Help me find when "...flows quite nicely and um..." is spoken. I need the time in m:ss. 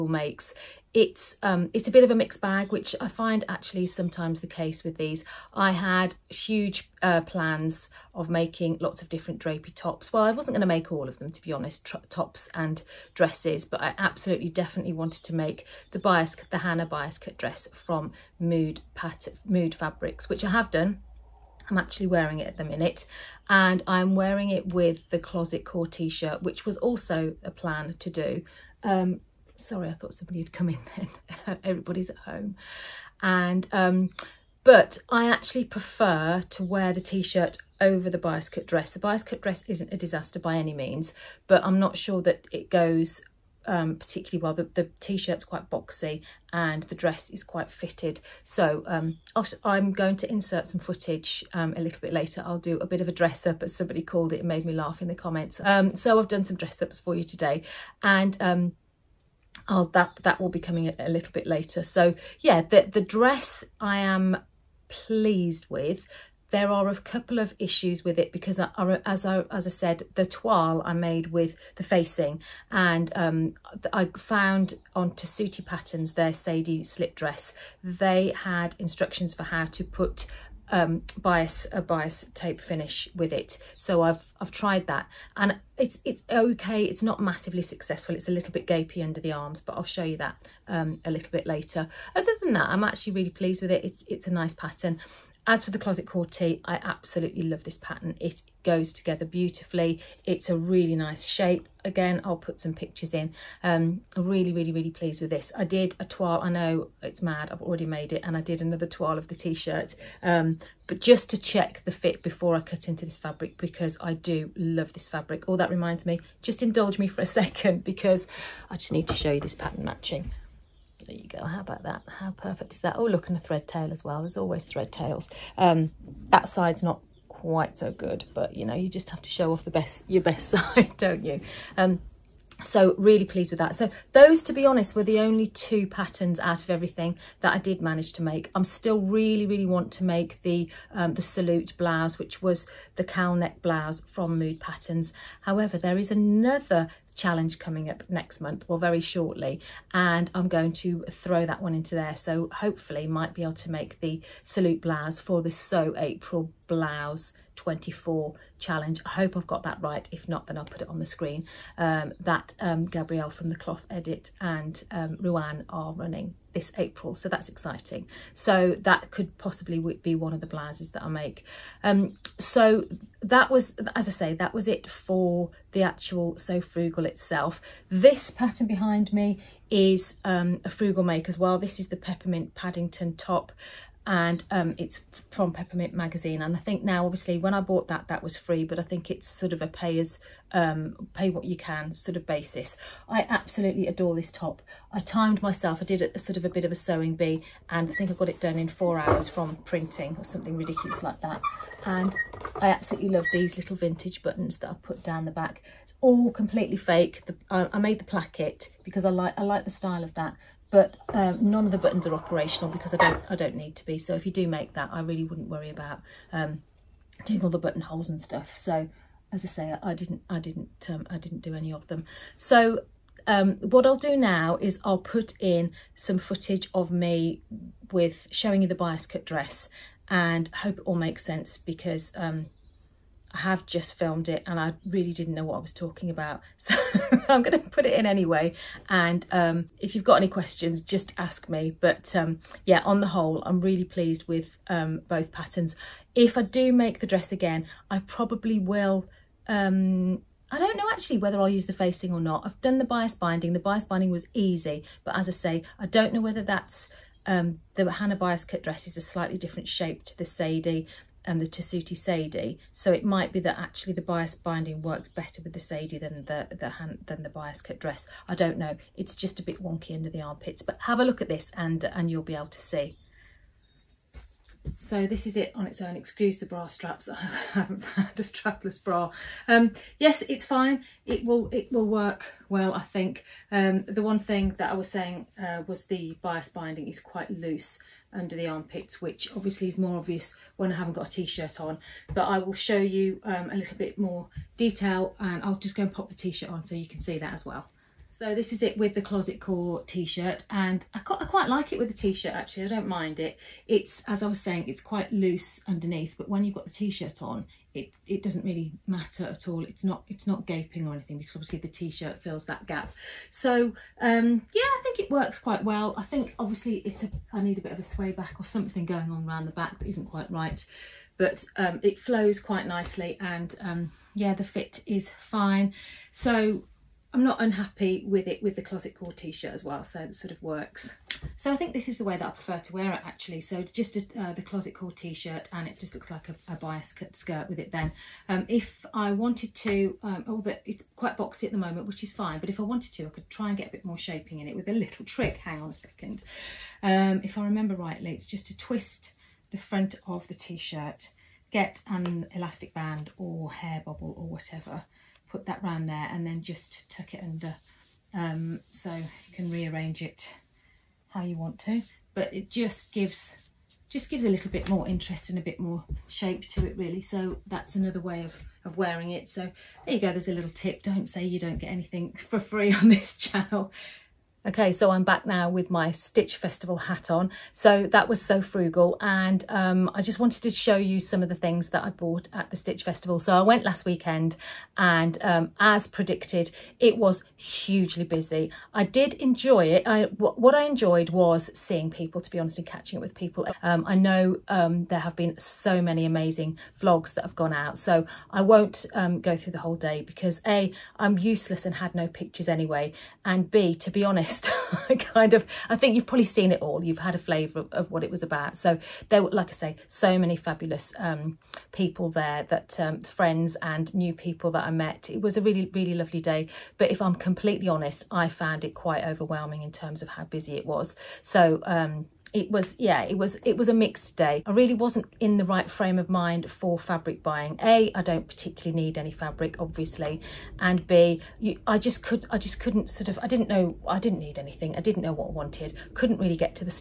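5:21.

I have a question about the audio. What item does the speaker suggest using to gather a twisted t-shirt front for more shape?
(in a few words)
Elastic band.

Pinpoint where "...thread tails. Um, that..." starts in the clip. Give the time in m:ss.
2:04.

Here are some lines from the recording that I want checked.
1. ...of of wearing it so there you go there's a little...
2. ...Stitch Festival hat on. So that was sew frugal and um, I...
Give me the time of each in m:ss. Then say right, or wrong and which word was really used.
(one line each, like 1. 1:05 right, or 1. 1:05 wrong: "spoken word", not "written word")
1. 6:08 right
2. 6:15 right.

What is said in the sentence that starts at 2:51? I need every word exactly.
Um, so that was, as I say, that was it for the actual Sew Frugal itself.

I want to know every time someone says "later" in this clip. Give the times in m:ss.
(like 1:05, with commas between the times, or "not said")
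0:52, 1:01, 1:31.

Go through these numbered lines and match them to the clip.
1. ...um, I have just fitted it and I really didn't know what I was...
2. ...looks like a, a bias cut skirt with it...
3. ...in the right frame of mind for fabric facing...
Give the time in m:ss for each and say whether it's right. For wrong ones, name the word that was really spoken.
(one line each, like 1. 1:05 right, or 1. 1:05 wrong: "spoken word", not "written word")
1. 3:52 wrong: "filmed", not "fitted"
2. 5:35 right
3. 7:05 wrong: "buying", not "facing".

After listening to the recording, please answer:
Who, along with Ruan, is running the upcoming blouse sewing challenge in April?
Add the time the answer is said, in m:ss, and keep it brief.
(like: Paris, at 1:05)
Gabrielle, at 2:42.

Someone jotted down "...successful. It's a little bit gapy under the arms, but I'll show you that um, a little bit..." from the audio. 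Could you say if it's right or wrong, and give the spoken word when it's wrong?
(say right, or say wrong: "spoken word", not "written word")
right.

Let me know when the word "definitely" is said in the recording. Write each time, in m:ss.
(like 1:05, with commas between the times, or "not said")
0:14.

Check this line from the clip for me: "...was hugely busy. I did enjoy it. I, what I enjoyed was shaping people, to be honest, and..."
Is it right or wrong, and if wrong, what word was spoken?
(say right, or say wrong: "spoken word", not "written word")
wrong: "seeing", not "shaping".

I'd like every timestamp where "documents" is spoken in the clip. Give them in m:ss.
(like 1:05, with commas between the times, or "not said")
not said.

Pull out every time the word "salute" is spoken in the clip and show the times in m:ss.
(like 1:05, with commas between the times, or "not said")
2:21, 2:34.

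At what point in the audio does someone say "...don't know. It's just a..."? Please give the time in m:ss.
4:28.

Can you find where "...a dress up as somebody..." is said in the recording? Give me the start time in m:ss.
0:53.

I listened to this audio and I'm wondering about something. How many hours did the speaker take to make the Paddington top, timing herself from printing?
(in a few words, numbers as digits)
4.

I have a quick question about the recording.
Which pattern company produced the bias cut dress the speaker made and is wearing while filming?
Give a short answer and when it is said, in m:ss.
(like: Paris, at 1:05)
Mood Fabrics, at 0:19.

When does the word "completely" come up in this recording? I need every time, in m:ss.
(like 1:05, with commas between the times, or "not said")
3:26, 6:57.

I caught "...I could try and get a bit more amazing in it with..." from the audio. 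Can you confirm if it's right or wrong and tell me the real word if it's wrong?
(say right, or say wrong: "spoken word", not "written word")
wrong: "shaping", not "amazing".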